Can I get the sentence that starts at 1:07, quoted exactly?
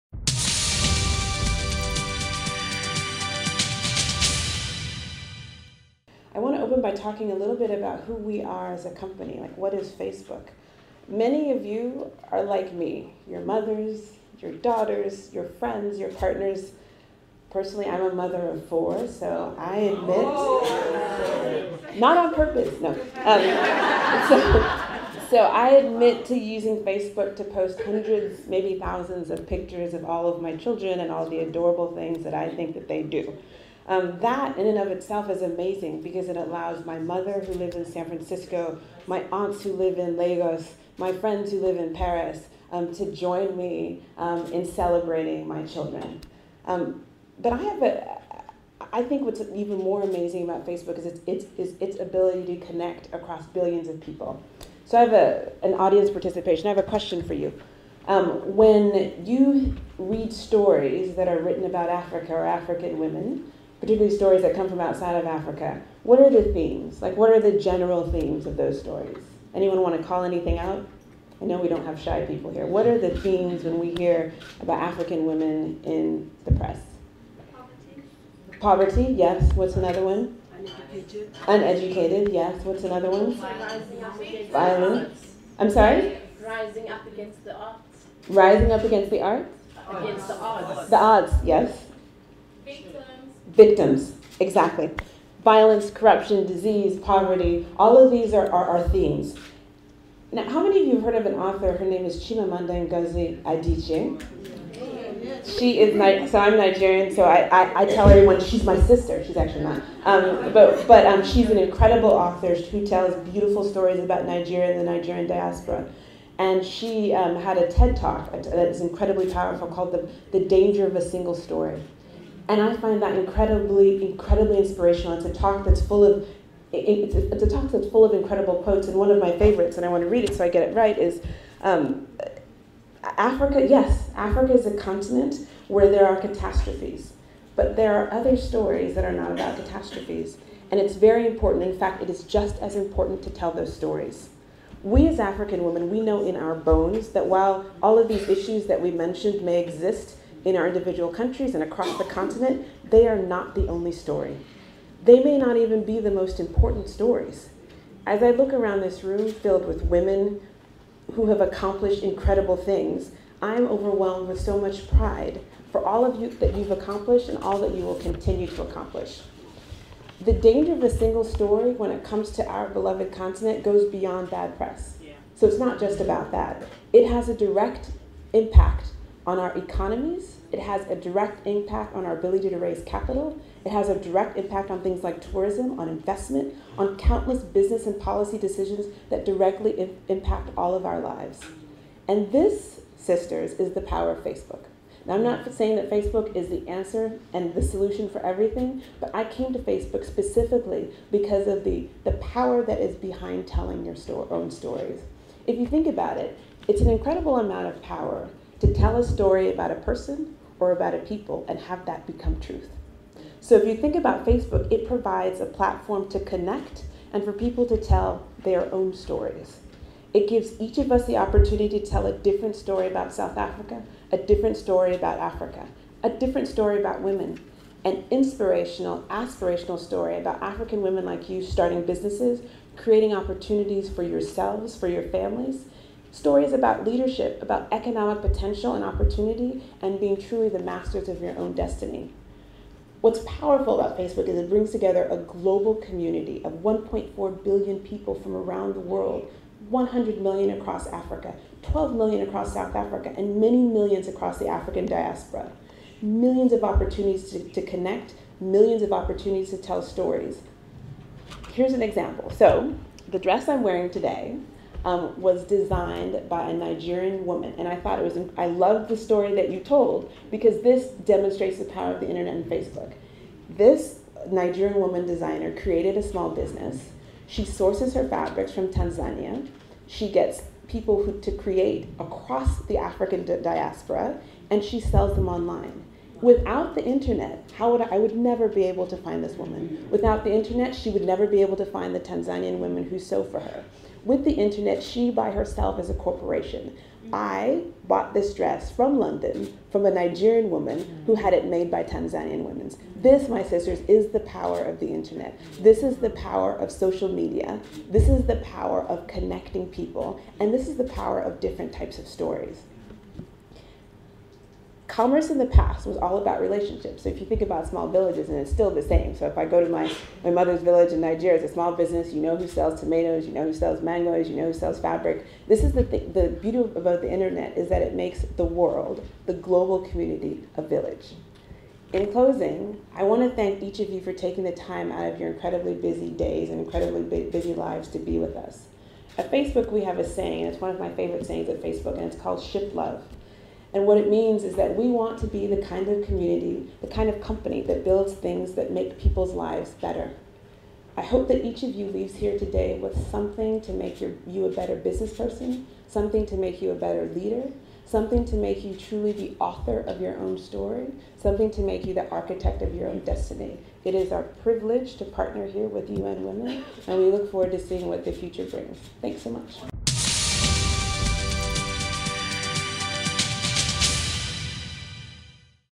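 Like, what are the general themes of those stories?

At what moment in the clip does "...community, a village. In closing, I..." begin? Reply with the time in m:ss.
5:29.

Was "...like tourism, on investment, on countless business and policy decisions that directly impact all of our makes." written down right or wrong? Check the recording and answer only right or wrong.
wrong.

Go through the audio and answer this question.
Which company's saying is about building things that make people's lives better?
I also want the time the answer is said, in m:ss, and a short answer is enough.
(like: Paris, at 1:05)
Ship Love, at 5:42.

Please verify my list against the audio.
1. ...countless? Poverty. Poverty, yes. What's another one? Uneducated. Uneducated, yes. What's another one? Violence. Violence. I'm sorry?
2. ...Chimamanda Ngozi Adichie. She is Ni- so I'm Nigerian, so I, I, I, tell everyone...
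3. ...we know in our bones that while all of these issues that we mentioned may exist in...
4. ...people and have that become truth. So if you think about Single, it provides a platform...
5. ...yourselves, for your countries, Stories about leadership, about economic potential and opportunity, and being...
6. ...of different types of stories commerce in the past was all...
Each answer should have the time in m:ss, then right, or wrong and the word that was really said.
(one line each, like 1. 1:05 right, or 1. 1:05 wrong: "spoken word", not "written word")
1. 1:16 wrong: "press", not "countless"
2. 1:42 right
3. 2:25 right
4. 3:30 wrong: "Facebook", not "Single"
5. 3:54 wrong: "families", not "countries"
6. 5:11 right.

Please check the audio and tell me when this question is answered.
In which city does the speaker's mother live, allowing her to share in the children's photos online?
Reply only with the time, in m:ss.
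0:37.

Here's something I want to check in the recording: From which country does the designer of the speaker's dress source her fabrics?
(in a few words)
Tanzania.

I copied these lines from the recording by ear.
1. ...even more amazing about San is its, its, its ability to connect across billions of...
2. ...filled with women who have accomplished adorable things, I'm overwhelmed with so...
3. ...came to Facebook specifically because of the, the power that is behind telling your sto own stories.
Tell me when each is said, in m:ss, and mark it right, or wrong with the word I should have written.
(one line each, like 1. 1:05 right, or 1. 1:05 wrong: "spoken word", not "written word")
1. 0:49 wrong: "Facebook", not "San"
2. 2:39 wrong: "incredible", not "adorable"
3. 3:19 right.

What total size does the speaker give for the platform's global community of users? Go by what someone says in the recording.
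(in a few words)
1.4 billion.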